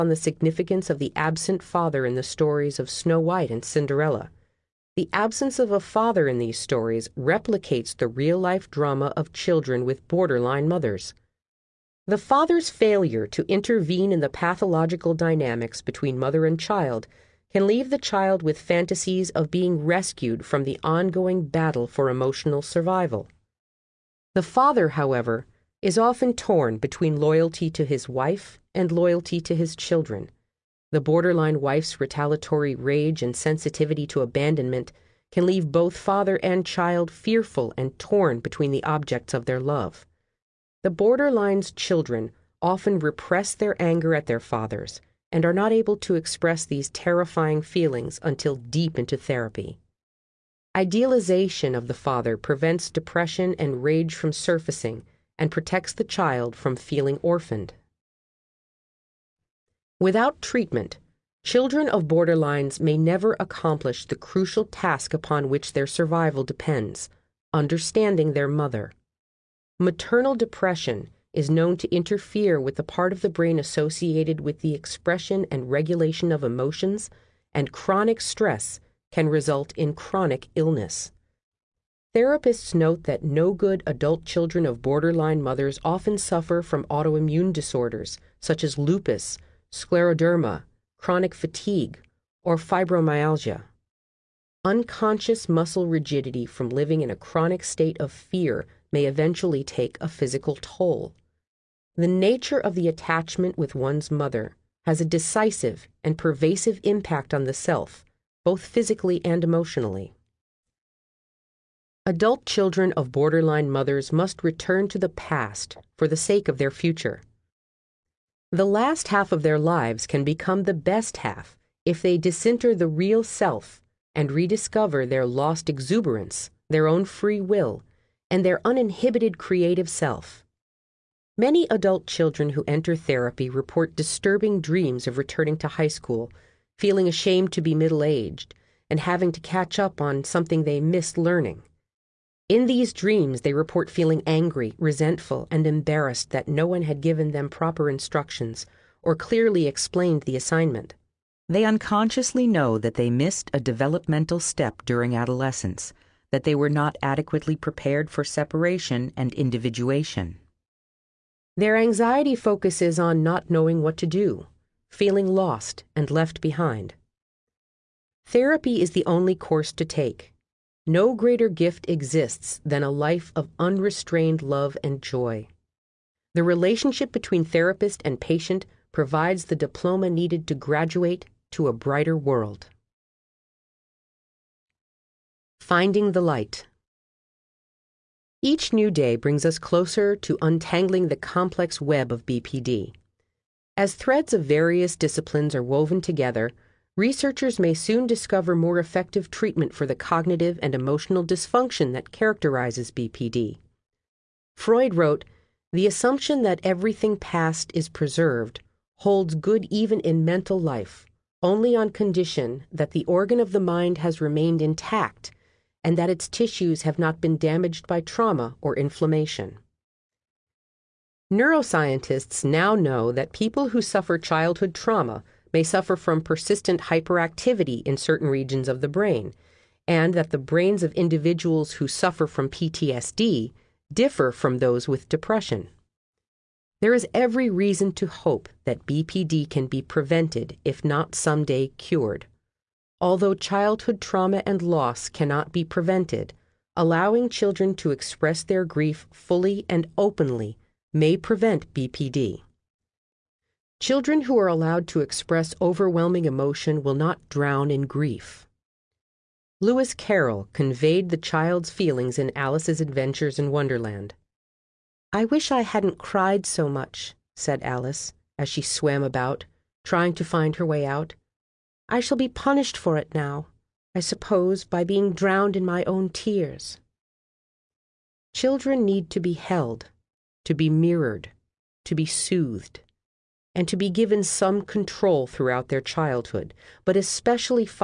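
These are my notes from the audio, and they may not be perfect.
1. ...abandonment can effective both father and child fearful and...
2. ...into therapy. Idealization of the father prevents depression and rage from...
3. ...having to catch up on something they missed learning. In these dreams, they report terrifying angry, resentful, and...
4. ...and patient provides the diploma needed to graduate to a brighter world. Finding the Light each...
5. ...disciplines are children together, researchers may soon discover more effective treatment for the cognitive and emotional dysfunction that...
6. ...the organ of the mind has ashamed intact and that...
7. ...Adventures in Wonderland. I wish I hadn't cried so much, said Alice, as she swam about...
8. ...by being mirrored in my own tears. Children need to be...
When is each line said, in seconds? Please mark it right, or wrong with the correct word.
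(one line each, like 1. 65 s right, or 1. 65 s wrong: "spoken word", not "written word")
1. 34 s wrong: "leave", not "effective"
2. 48 s right
3. 138 s wrong: "feeling", not "terrifying"
4. 178 s right
5. 194 s wrong: "woven", not "children"
6. 212 s wrong: "remained", not "ashamed"
7. 262 s right
8. 274 s wrong: "drowned", not "mirrored".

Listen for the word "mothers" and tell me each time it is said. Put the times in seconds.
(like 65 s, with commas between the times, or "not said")
10 s, 16 s, 68 s, 85 s, 104 s, 113 s.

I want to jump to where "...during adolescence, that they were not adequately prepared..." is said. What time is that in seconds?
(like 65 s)
154 s.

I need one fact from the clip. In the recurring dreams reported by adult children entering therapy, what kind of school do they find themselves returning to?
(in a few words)
High school.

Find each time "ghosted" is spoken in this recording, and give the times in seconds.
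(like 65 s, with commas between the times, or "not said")
not said.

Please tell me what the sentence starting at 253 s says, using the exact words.
Children who are allowed to express overwhelming emotion will not drown in grief.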